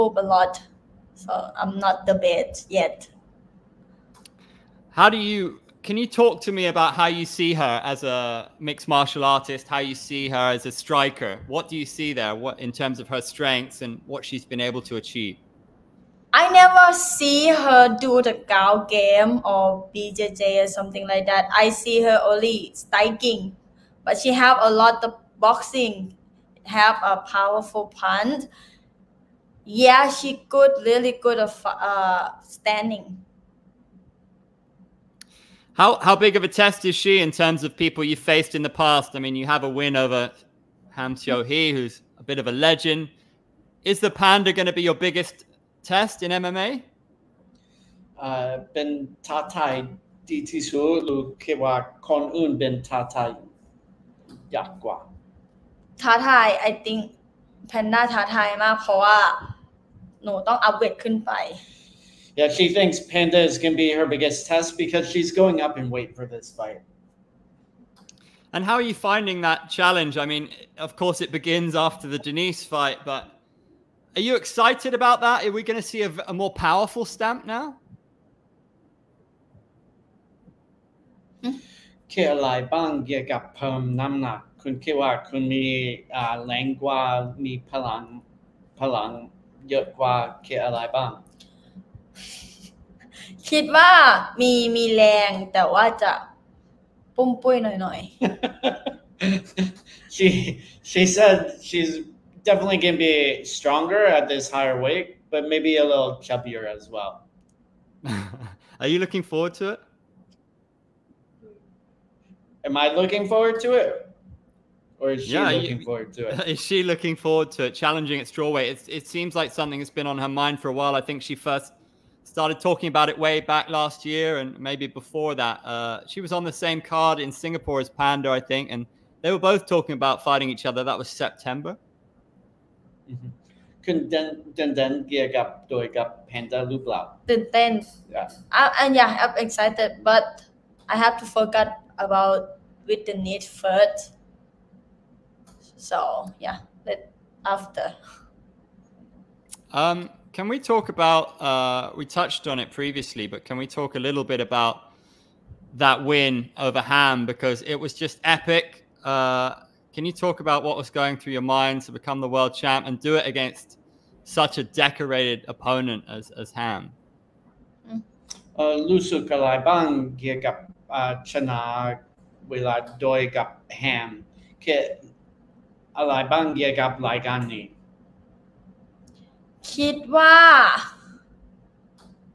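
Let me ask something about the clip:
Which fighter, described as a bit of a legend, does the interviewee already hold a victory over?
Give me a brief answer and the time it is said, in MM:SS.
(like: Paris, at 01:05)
Ham Seo Hee, at 00:40.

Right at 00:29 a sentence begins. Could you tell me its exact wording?
Yeah, she good, really good of uh, standing.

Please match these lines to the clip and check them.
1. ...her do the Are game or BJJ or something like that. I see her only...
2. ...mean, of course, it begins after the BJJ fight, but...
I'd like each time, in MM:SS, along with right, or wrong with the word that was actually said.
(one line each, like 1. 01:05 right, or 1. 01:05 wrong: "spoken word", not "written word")
1. 00:17 wrong: "Gao", not "Are"
2. 01:10 wrong: "Denise", not "BJJ".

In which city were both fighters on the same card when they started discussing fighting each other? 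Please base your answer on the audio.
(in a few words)
Singapore.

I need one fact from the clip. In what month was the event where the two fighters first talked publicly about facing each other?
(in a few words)
September.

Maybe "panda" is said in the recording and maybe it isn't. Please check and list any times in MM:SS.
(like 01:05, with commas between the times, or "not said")
00:44, 01:02, 02:07, 02:16.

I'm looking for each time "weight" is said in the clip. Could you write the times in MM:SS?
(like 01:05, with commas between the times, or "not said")
01:05, 01:44, 01:58.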